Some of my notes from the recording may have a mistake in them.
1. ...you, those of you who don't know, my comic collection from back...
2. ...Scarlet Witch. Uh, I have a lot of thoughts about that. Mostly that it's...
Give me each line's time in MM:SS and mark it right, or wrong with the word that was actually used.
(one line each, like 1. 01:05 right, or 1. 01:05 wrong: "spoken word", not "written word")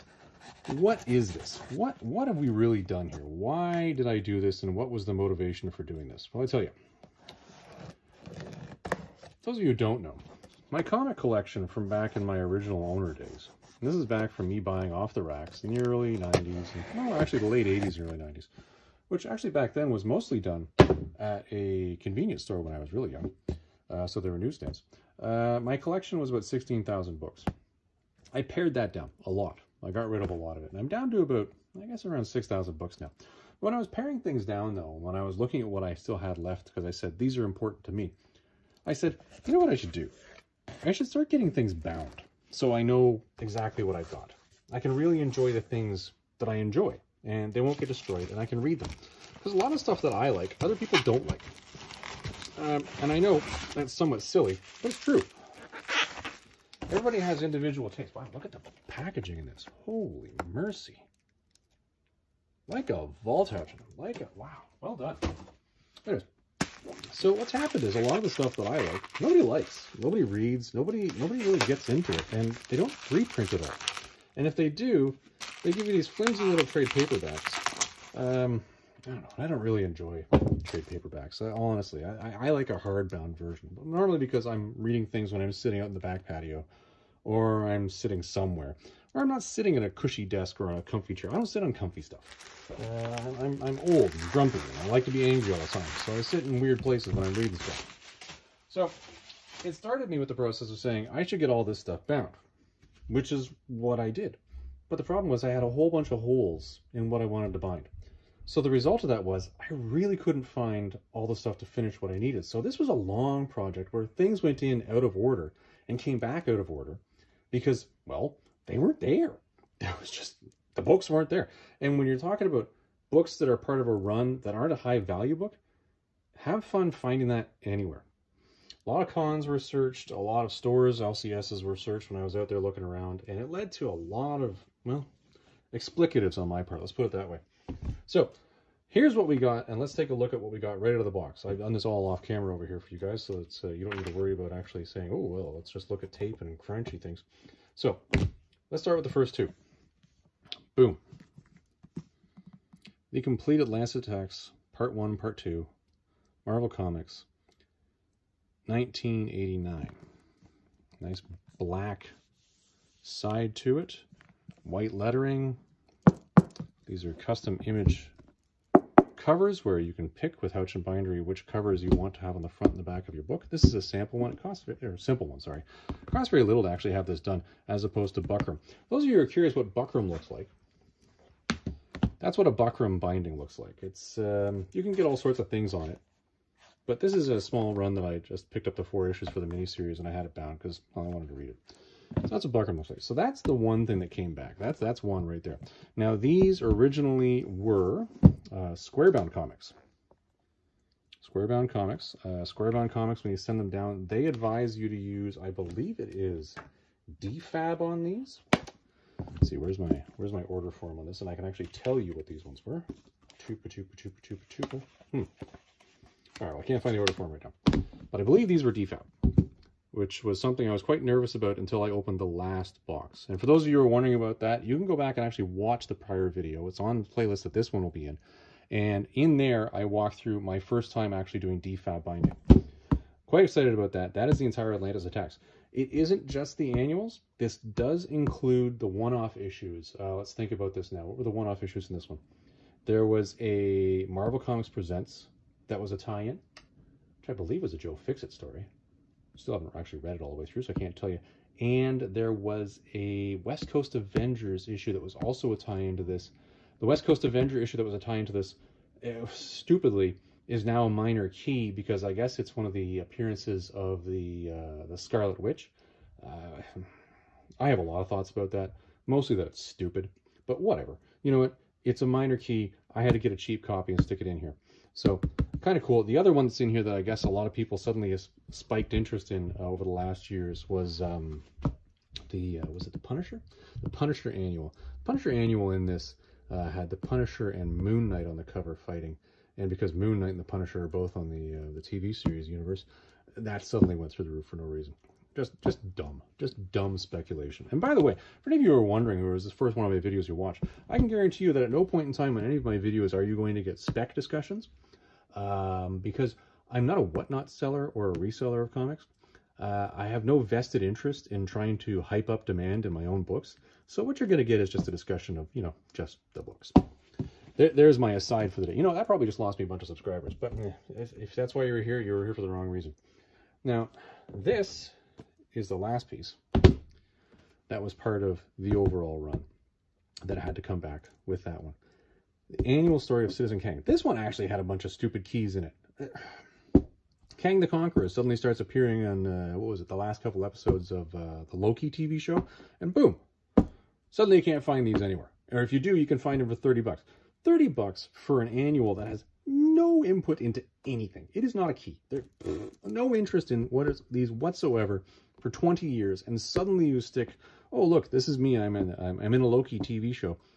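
1. 00:06 right
2. 04:24 right.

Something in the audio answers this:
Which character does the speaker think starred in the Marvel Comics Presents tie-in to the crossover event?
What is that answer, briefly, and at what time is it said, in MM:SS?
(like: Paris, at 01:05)
Joe Fixit, at 04:07.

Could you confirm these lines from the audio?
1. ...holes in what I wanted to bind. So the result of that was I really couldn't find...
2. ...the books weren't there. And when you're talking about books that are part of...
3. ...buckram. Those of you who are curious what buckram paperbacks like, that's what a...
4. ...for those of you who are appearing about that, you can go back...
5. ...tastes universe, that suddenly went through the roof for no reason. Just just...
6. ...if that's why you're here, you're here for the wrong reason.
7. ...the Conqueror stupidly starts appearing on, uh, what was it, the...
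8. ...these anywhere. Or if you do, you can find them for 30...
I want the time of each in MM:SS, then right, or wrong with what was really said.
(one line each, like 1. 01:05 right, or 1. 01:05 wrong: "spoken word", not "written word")
1. 01:46 right
2. 02:00 right
3. 02:58 wrong: "looks", not "paperbacks"
4. 03:43 wrong: "wondering", not "appearing"
5. 04:52 wrong: "series", not "tastes"
6. 05:21 right
7. 05:37 wrong: "suddenly", not "stupidly"
8. 05:44 right.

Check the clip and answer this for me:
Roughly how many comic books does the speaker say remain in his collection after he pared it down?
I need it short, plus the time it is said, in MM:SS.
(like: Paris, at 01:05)
6,000, at 00:32.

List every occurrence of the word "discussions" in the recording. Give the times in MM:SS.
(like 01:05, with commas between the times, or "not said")
05:04, 05:14.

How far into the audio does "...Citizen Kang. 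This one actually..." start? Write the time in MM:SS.
05:33.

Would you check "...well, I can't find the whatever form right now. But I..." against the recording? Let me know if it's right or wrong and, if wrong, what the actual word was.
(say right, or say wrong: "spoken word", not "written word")
wrong: "order", not "whatever".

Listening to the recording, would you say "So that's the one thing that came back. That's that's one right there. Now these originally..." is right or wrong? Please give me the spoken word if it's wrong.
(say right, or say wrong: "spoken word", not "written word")
right.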